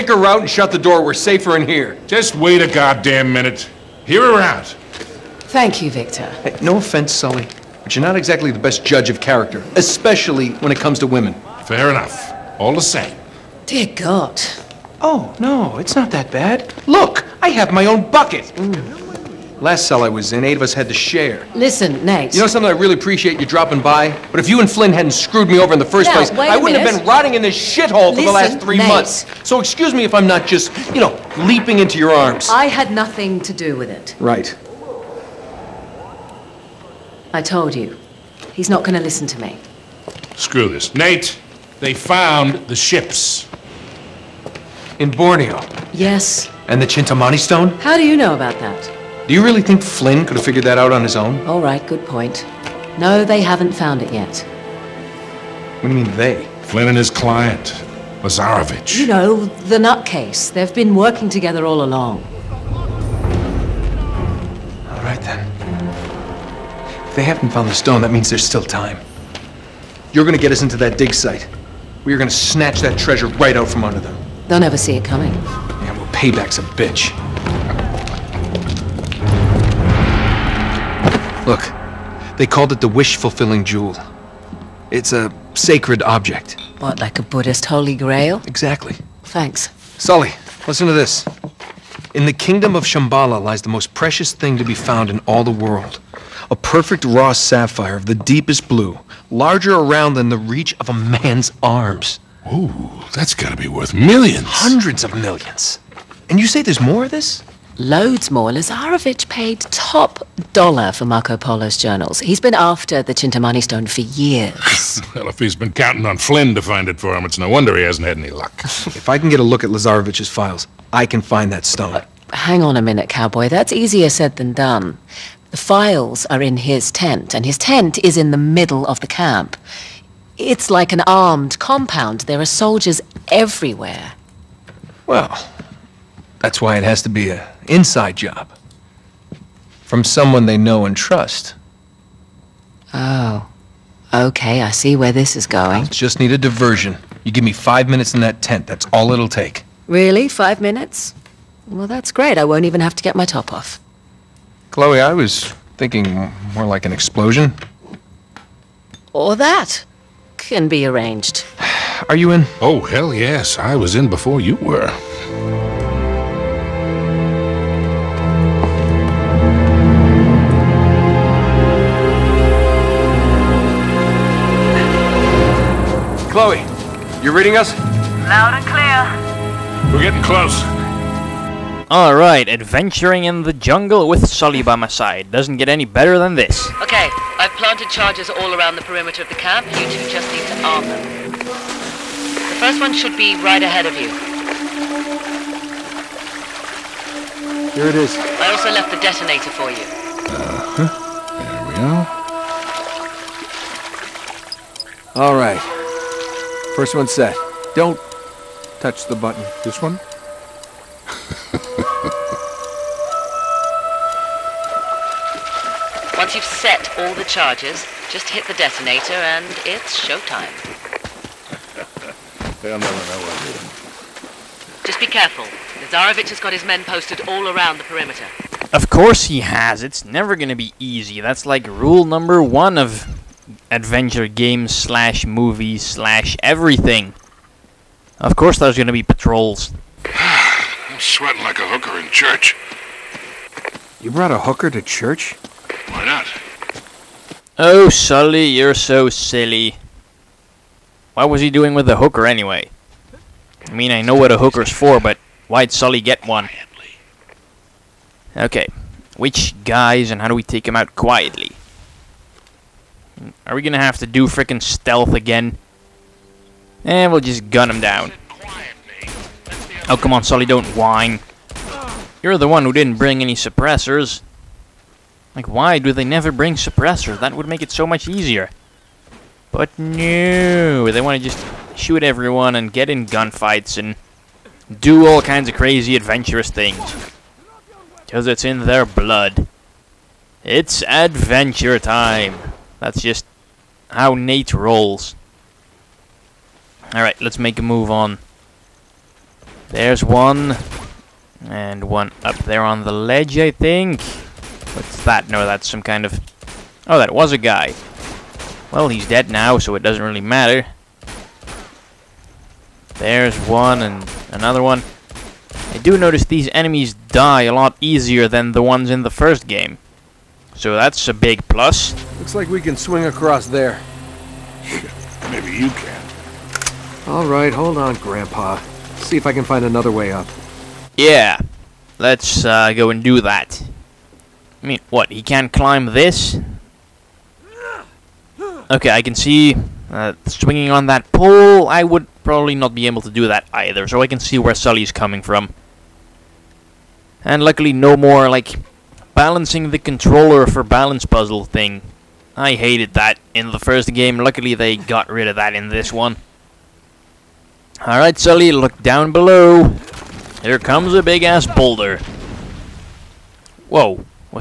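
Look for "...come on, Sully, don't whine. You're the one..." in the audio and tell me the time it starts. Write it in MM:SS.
04:29.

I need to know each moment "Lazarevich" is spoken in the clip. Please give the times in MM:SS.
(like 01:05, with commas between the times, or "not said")
00:58, 01:48, 01:59.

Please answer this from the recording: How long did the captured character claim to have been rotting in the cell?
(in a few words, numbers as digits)
3 months.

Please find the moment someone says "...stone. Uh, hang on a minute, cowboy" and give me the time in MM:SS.
02:01.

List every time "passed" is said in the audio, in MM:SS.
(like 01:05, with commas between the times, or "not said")
not said.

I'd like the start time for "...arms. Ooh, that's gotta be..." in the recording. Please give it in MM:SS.
01:41.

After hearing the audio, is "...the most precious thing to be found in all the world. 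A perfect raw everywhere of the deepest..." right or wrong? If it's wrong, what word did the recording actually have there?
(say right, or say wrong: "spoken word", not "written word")
wrong: "sapphire", not "everywhere".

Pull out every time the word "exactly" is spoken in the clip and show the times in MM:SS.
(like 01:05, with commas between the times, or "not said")
00:08, 01:28.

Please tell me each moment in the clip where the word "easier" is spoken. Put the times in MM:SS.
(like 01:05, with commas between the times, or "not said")
02:03, 04:38, 05:17.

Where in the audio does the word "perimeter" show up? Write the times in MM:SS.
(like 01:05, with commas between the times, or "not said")
03:08, 03:47.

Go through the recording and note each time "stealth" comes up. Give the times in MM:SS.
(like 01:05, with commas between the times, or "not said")
04:24.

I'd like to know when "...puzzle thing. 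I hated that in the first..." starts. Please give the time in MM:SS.
05:51.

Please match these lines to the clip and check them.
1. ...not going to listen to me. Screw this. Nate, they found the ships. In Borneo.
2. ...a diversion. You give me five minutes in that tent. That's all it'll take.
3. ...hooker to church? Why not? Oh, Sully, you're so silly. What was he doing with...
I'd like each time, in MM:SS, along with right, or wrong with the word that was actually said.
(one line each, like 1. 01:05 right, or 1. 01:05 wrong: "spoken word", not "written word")
1. 00:38 right
2. 02:26 right
3. 04:04 right.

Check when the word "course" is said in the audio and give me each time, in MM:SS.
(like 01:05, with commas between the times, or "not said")
03:48, 03:58.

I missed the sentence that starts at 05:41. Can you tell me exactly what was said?
I would probably not be able to do that either, so I can see where Sully's coming from.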